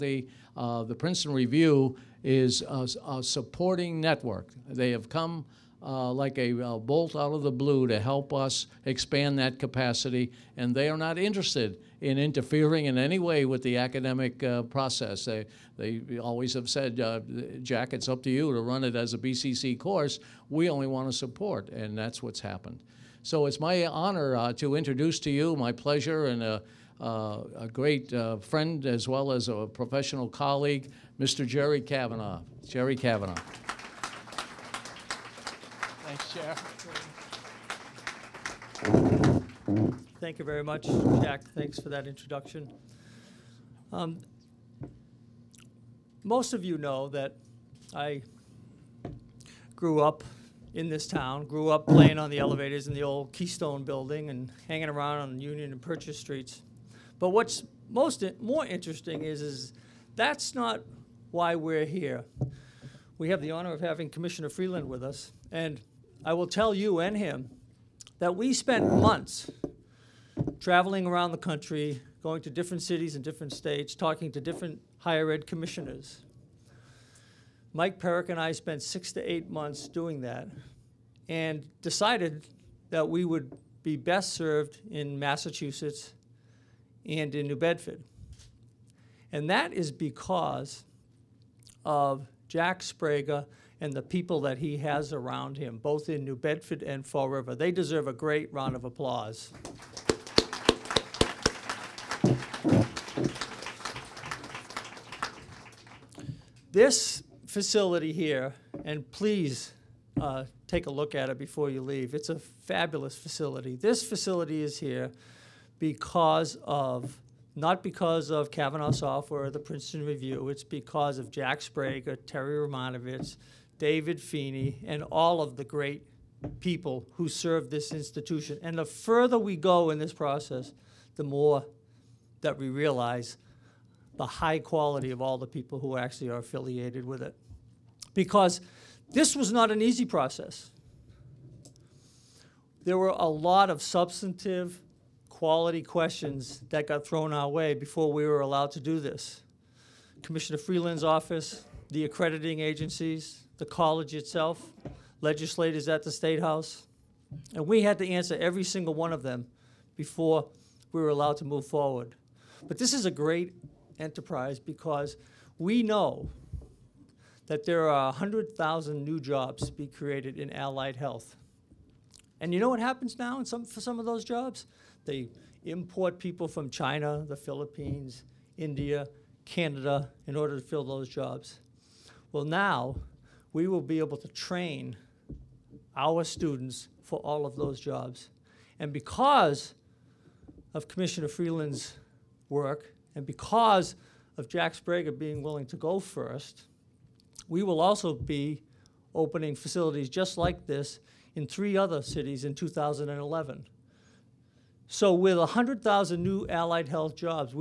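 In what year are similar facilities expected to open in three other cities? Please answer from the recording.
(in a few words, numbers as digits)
2011.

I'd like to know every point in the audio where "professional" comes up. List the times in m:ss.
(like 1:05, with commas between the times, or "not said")
0:29.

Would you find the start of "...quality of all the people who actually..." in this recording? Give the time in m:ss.
2:14.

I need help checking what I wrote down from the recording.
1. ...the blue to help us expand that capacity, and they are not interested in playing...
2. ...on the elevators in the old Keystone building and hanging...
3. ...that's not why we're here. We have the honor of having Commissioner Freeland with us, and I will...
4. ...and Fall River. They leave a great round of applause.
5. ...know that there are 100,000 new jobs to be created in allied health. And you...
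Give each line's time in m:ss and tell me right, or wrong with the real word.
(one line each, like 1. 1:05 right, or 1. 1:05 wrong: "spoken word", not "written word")
1. 0:07 wrong: "interfering", not "playing"
2. 0:52 right
3. 1:00 right
4. 1:36 wrong: "deserve", not "leave"
5. 2:45 right.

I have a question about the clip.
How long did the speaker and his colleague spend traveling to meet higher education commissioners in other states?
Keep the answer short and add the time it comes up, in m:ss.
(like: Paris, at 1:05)
6 to 8 months, at 1:18.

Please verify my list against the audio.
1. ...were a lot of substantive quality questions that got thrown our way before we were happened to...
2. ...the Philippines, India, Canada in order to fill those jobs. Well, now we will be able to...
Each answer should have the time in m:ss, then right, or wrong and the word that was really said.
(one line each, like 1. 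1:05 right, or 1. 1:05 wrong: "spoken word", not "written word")
1. 2:22 wrong: "allowed", not "happened"
2. 2:57 right.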